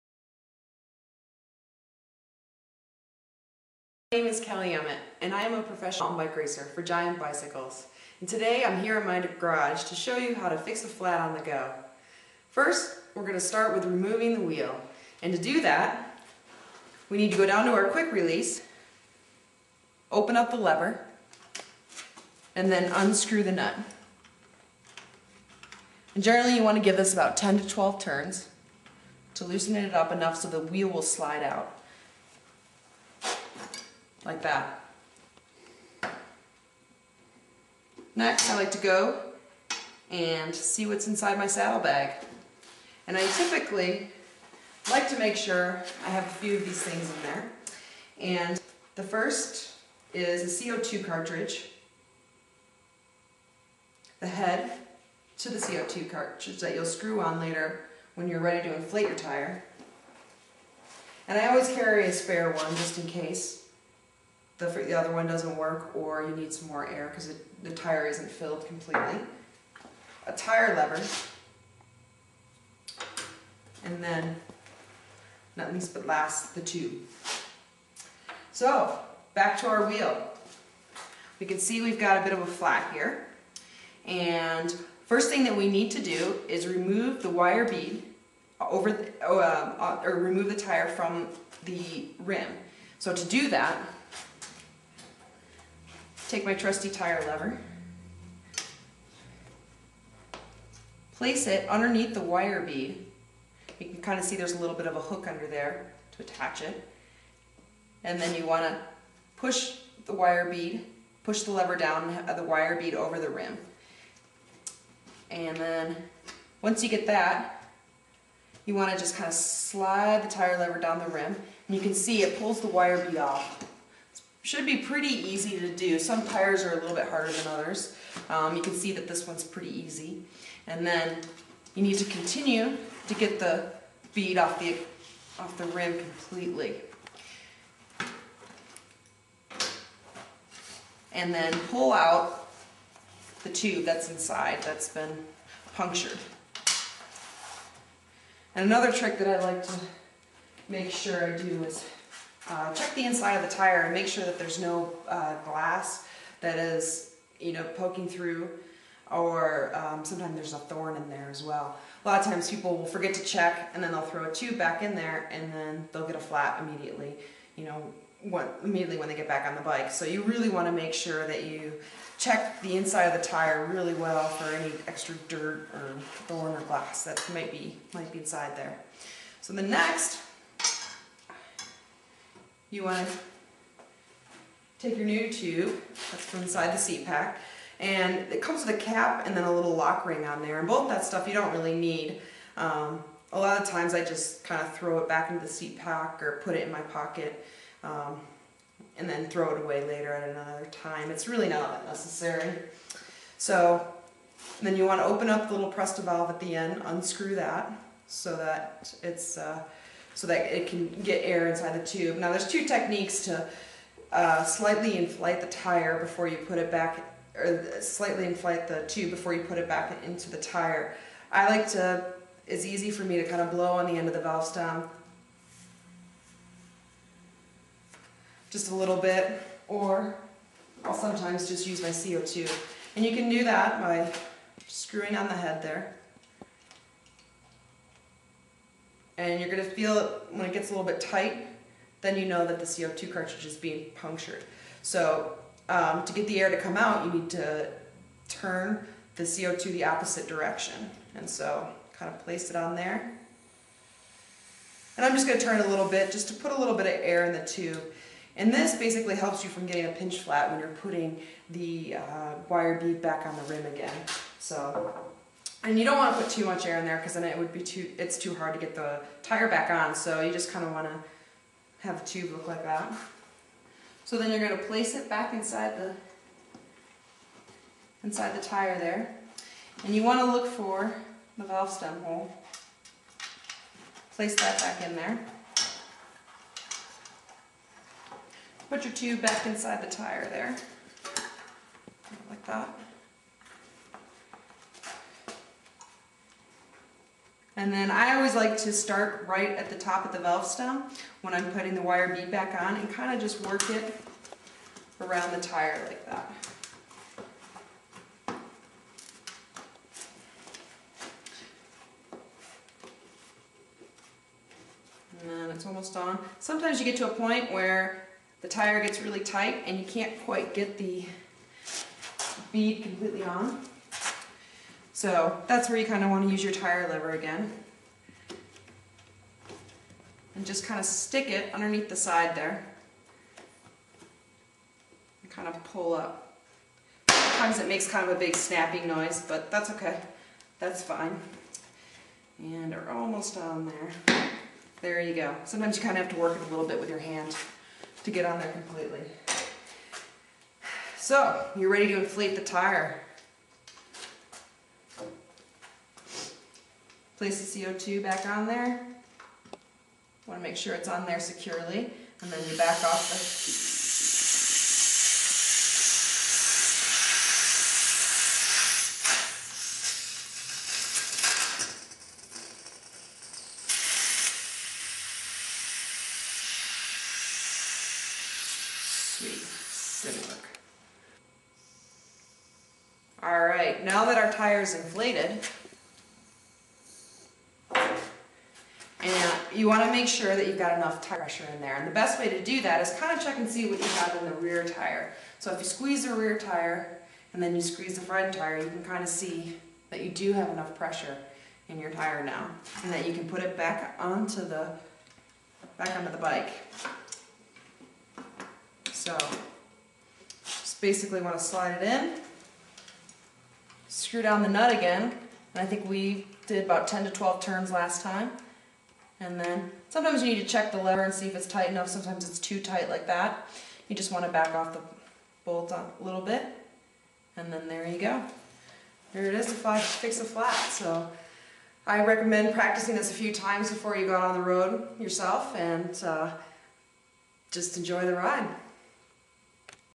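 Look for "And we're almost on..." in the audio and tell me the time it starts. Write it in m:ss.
5:42.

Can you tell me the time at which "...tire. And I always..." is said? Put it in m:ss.
0:59.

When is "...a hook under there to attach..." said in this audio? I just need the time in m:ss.
1:44.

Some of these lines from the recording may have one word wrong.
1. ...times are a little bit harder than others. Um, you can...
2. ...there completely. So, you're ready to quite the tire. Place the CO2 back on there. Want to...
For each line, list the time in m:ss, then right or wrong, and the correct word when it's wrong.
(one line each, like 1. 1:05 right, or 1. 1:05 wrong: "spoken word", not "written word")
1. 2:06 wrong: "tires", not "times"
2. 5:48 wrong: "inflate", not "quite".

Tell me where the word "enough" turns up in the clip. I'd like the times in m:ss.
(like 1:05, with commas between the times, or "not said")
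0:30, 6:30, 6:40, 7:01.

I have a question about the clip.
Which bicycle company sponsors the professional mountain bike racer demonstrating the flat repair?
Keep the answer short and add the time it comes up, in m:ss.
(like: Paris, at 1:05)
Giant Bicycles, at 0:06.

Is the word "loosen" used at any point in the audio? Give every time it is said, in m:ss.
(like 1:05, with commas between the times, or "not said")
0:29.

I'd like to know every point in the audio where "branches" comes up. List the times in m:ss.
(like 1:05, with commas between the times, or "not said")
not said.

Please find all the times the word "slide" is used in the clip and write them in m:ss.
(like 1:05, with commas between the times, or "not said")
0:31, 1:59, 6:51.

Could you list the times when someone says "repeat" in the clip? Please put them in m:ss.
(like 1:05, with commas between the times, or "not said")
not said.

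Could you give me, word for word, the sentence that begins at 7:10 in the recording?
So I recommend practicing this a few times before you go out on the road yourself and uh, just enjoy the ride.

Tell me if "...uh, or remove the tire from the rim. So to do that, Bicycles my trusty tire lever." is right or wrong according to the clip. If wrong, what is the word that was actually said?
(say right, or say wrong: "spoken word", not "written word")
wrong: "Take", not "Bicycles".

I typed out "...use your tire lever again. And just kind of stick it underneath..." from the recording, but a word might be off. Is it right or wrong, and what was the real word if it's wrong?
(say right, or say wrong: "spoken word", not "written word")
right.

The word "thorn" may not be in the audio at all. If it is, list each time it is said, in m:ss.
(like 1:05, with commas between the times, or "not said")
2:40, 2:56.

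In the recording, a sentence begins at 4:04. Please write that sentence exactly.
So um, to get the air to come out, you need to turn the CO2 the opposite direction.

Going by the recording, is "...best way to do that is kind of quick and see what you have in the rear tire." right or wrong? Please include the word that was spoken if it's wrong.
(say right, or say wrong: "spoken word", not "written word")
wrong: "check", not "quick".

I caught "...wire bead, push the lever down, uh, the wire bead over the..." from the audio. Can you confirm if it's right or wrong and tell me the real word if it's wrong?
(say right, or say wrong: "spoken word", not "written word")
right.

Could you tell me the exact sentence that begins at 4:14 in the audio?
And I'm just going to turn it a little bit just to put a little bit of air in the tube.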